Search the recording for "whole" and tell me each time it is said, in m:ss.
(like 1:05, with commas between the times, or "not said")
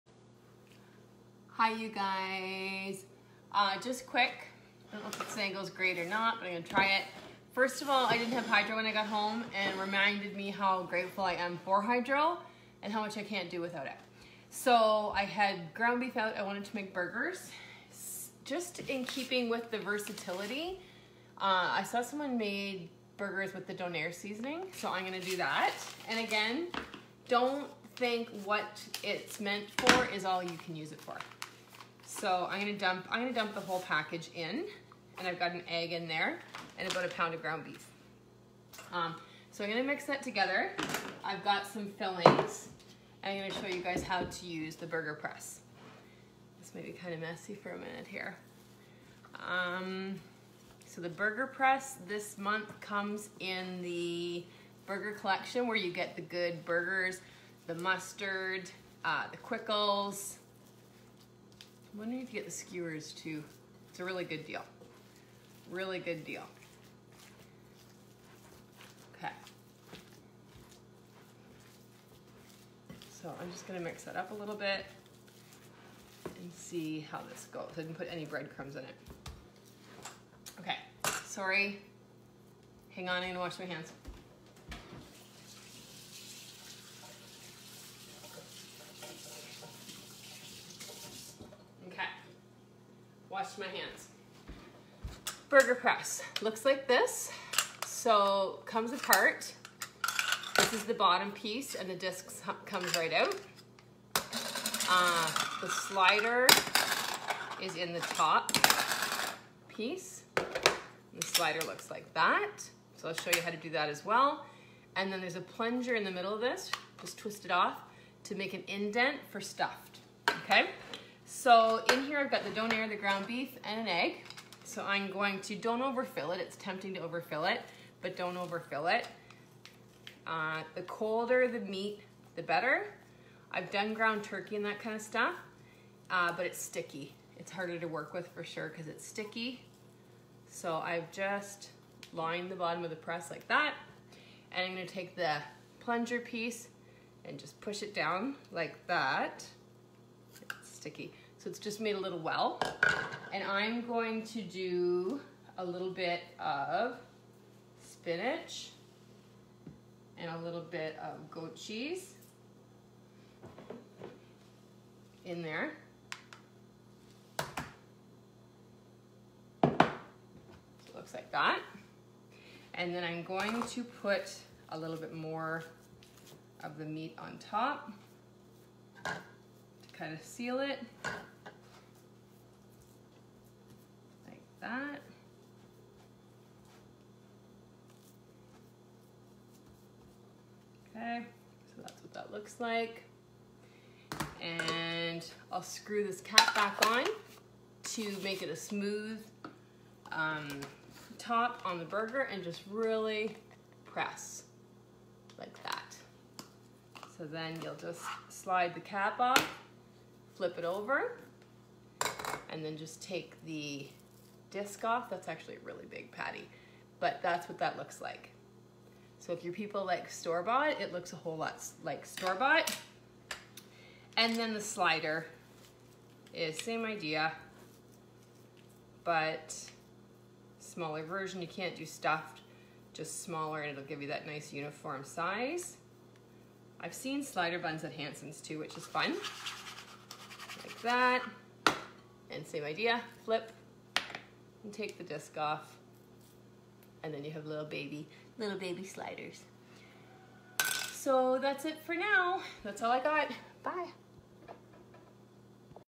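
0:33, 3:41.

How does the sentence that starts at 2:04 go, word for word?
So I'm going to, don't overfill it.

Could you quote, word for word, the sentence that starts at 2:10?
Uh, the colder the meat, the better.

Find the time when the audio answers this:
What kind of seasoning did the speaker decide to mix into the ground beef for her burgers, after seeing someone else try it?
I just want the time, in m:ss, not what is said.
0:23.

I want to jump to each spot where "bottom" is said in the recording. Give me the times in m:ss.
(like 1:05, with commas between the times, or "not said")
1:40, 2:22.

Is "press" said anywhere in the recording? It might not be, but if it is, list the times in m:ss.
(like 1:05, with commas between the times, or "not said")
0:45, 0:51, 1:35, 2:22, 3:23.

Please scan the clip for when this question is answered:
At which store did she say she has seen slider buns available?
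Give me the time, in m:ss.
3:57.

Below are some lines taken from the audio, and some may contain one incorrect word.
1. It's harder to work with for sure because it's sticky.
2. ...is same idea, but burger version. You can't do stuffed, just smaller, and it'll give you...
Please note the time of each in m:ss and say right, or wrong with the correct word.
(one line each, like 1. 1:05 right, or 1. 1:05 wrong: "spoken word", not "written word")
1. 2:17 right
2. 3:46 wrong: "smaller", not "burger".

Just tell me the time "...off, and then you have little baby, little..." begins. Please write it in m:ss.
4:05.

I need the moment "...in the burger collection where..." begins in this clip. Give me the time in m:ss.
0:53.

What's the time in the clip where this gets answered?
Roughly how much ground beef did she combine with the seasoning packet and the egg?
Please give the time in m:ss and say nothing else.
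0:36.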